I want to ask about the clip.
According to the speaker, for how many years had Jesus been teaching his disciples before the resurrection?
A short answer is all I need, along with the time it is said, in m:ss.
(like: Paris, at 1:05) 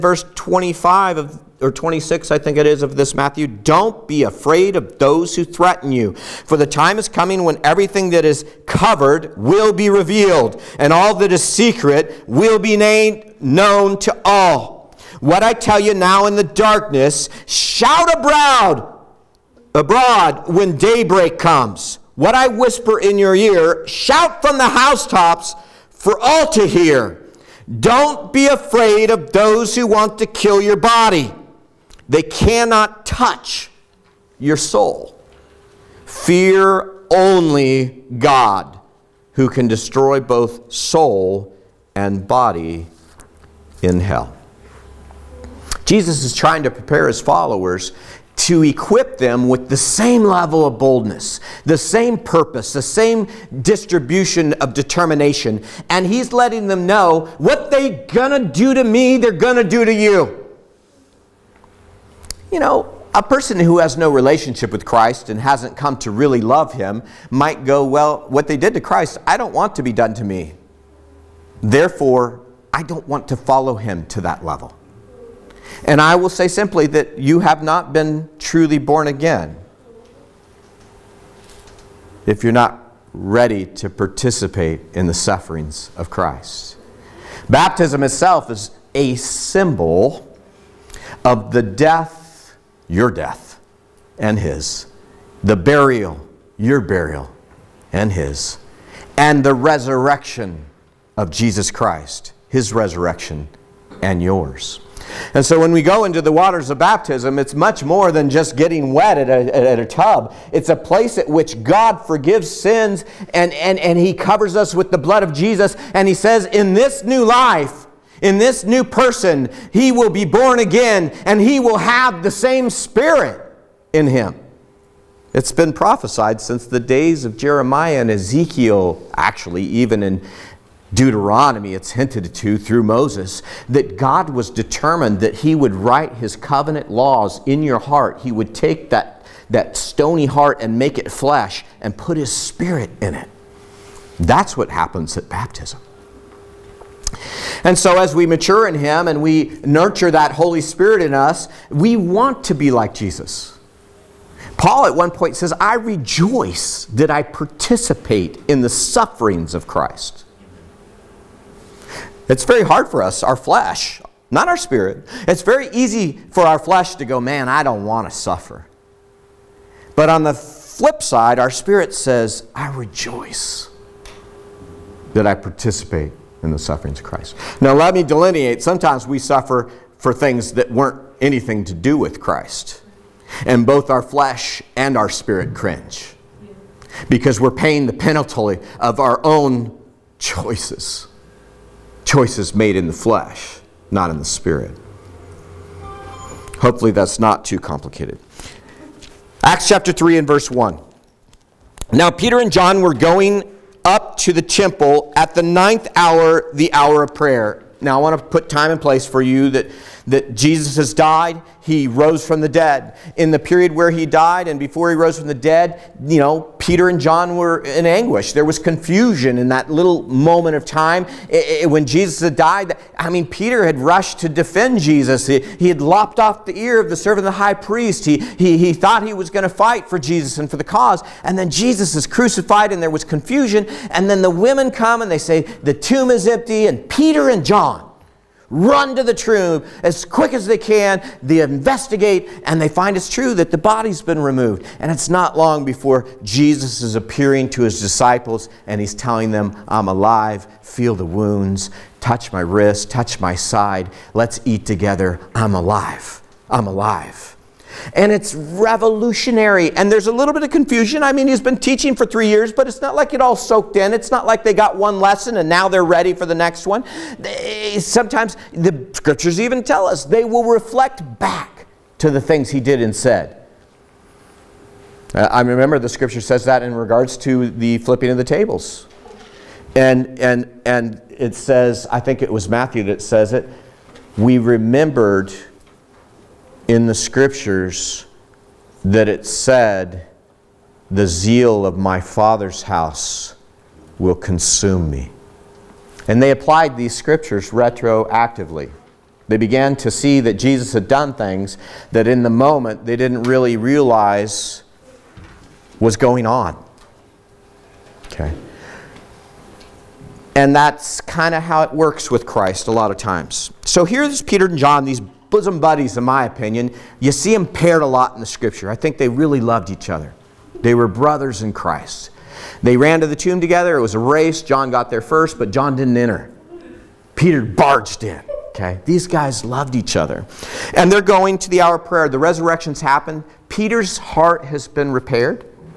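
3 years, at 4:22.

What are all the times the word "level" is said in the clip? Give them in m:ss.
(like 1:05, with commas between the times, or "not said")
0:50, 1:14.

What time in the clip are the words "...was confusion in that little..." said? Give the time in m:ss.
3:38.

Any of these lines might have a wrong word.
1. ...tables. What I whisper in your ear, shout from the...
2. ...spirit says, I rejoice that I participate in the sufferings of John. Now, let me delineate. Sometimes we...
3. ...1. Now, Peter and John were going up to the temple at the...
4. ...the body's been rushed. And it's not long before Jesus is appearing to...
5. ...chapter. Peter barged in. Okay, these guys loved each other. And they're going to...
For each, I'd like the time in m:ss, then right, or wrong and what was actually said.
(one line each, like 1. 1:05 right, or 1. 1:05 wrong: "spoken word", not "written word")
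1. 0:21 wrong: "comes", not "tables"
2. 2:51 wrong: "Christ", not "John"
3. 3:20 right
4. 4:03 wrong: "removed", not "rushed"
5. 5:25 wrong: "enter", not "chapter".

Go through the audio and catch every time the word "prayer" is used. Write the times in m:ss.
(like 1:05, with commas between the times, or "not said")
3:27, 5:31.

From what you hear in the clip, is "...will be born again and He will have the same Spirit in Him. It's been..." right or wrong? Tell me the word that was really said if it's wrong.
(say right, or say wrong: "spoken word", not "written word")
right.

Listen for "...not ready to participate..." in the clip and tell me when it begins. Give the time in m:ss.
1:22.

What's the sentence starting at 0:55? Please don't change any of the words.
And he's letting them know what they gonna do to me, they're gonna do to you.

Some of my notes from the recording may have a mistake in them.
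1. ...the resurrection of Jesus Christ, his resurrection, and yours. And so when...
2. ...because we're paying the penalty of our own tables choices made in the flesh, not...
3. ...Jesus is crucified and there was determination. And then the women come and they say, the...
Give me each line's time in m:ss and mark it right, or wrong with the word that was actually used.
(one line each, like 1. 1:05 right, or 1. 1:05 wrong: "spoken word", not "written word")
1. 1:39 right
2. 3:07 wrong: "choices", not "tables"
3. 3:51 wrong: "confusion", not "determination".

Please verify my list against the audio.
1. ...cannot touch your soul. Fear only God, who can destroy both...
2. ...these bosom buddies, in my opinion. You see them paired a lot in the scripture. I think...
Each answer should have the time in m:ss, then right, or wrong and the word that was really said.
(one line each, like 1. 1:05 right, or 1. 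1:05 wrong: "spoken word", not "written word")
1. 0:32 right
2. 5:14 right.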